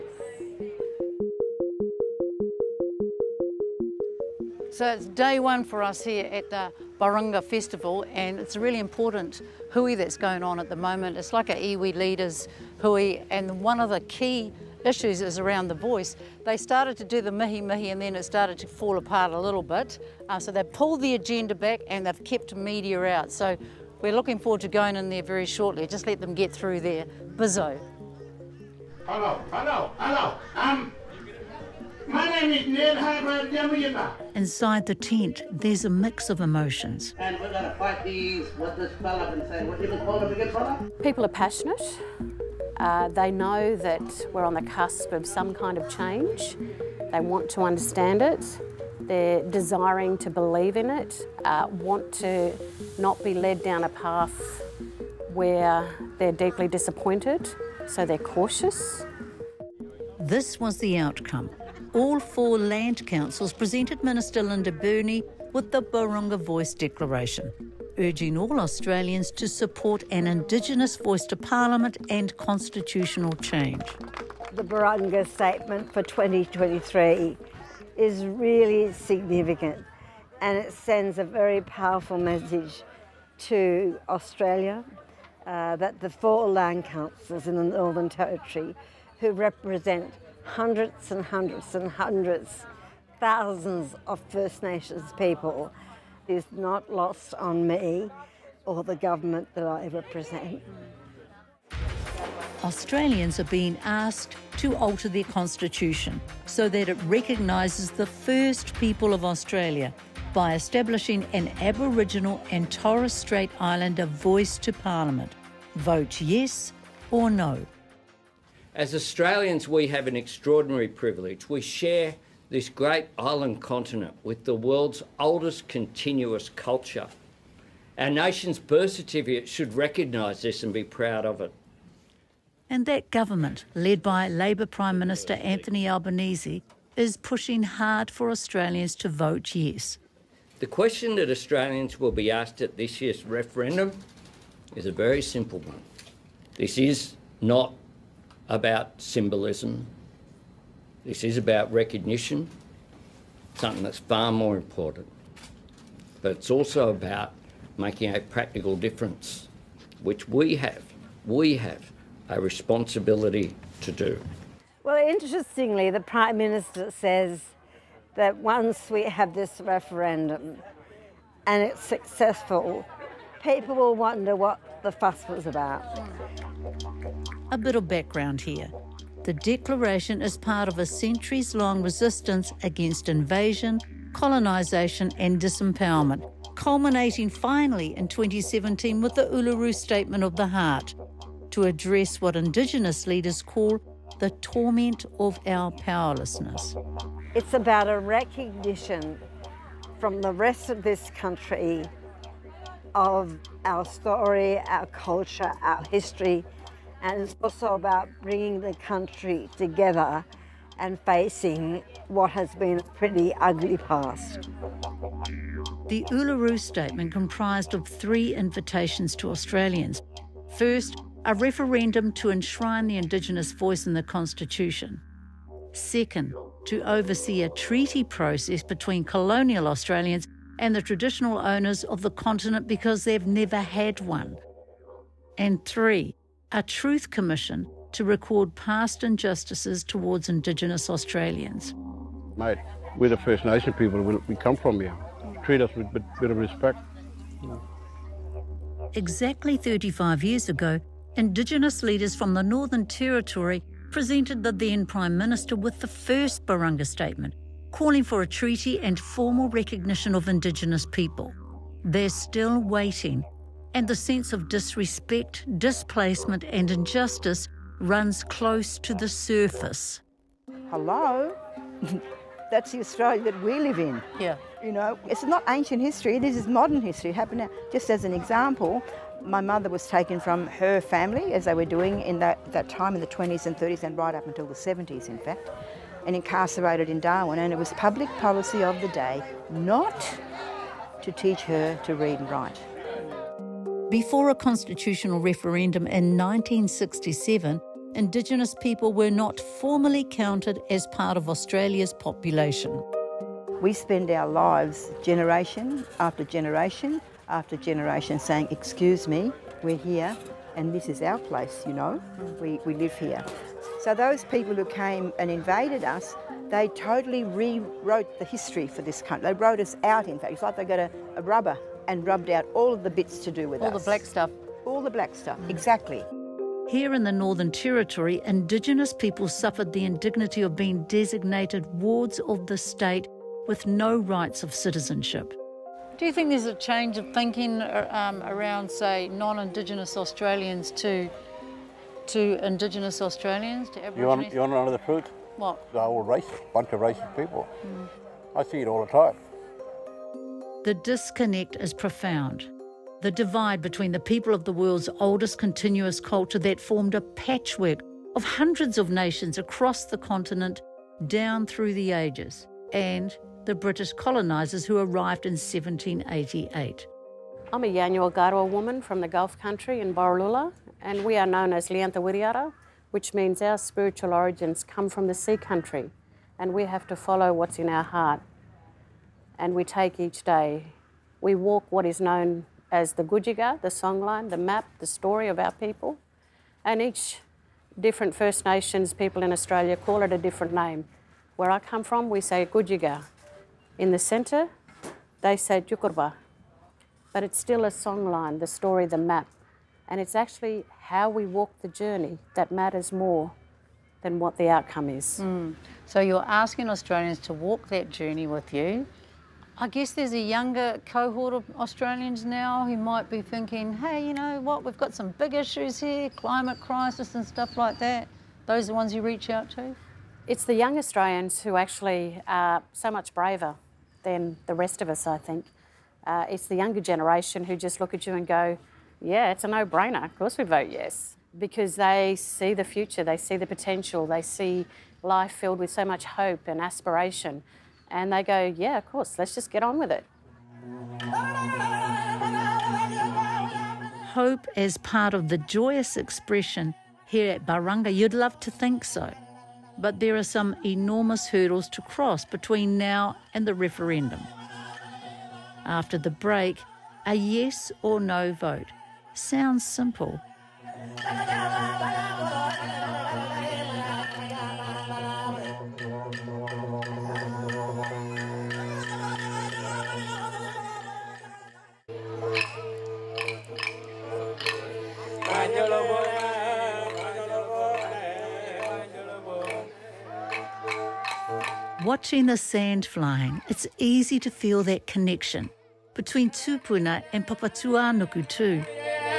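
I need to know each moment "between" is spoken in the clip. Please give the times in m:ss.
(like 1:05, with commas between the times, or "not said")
3:48, 5:53, 7:32, 8:05.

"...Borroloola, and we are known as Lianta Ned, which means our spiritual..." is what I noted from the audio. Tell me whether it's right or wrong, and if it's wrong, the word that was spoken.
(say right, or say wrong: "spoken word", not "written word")
wrong: "Wiriara", not "Ned".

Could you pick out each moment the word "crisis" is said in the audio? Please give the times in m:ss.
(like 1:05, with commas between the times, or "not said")
6:56.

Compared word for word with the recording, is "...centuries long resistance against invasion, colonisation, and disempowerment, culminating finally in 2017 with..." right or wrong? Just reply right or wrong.
right.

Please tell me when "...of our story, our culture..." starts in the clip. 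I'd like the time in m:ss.
3:22.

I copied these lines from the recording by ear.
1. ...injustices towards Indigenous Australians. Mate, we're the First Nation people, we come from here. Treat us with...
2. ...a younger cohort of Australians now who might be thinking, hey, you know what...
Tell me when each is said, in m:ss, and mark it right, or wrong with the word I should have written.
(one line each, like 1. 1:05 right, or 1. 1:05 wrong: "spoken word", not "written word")
1. 3:59 right
2. 6:50 right.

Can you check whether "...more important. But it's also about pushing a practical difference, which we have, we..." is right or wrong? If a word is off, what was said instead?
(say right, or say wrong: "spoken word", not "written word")
wrong: "making", not "pushing".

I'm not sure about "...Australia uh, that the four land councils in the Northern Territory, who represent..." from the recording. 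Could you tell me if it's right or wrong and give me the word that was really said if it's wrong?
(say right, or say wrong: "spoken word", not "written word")
right.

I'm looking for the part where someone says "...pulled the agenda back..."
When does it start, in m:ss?
0:20.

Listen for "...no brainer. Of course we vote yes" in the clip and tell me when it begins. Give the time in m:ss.
7:09.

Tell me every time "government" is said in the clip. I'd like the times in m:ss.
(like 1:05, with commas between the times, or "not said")
1:38, 2:13.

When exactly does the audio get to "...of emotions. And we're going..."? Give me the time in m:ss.
0:36.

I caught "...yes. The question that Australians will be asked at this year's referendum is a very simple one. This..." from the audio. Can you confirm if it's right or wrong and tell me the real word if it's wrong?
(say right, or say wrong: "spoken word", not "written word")
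right.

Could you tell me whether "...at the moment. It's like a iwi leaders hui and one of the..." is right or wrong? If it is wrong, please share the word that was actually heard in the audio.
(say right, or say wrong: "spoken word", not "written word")
right.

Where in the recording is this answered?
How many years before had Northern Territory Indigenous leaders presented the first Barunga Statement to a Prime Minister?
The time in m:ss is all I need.
4:09.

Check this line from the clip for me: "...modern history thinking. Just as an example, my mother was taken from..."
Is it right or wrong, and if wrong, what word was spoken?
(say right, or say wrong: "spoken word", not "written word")
wrong: "happening", not "thinking".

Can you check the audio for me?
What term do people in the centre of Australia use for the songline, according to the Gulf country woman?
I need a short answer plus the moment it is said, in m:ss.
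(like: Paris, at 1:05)
Jukurrpa, at 6:35.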